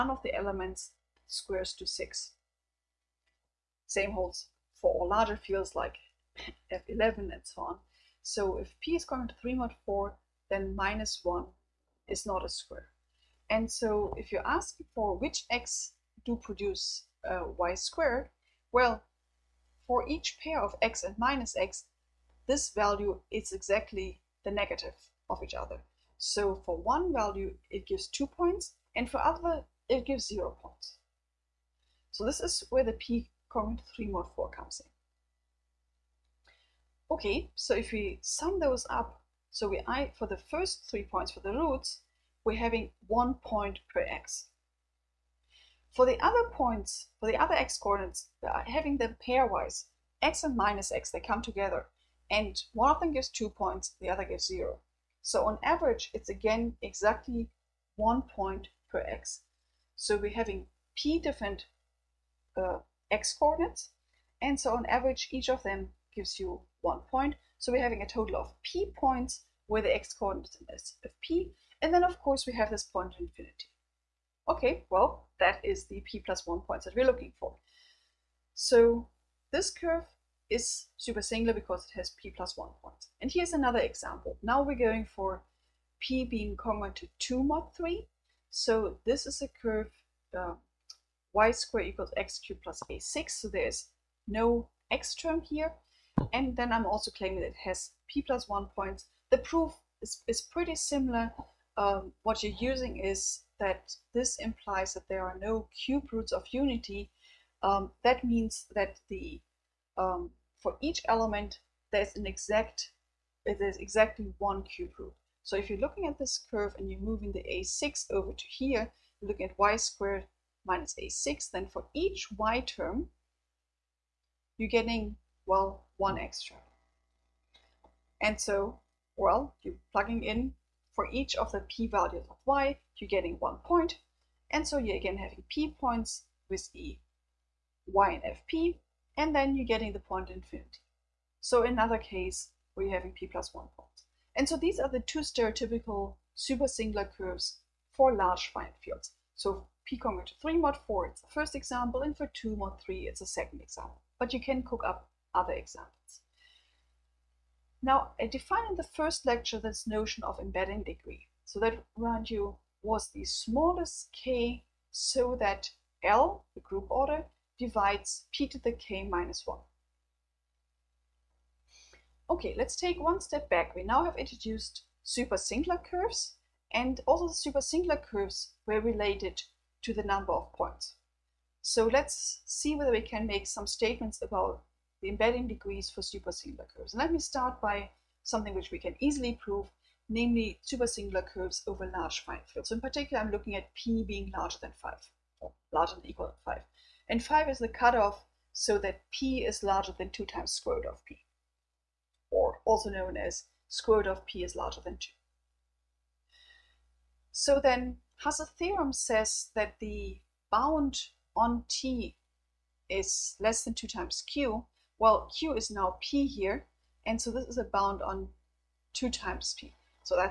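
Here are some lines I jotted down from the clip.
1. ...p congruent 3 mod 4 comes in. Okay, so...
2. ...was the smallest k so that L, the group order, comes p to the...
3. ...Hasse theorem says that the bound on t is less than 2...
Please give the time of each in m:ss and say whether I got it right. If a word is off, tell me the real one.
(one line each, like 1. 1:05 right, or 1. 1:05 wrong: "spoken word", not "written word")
1. 0:32 right
2. 2:42 wrong: "divides", not "comes"
3. 3:28 right.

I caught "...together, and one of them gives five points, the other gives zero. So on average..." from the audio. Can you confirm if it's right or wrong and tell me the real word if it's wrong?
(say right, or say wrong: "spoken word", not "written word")
wrong: "two", not "five".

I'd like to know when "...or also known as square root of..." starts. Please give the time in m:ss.
3:22.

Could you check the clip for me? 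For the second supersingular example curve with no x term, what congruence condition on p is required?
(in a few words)
2 mod 3.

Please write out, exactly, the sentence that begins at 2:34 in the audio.
But you can cook up other examples.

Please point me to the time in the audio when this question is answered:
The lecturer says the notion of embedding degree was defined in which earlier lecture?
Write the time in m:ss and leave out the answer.
2:38.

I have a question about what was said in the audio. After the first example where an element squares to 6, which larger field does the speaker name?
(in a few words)
F11.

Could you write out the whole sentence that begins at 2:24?
And so these are the two stereotypical supersingular curves for large finite fields.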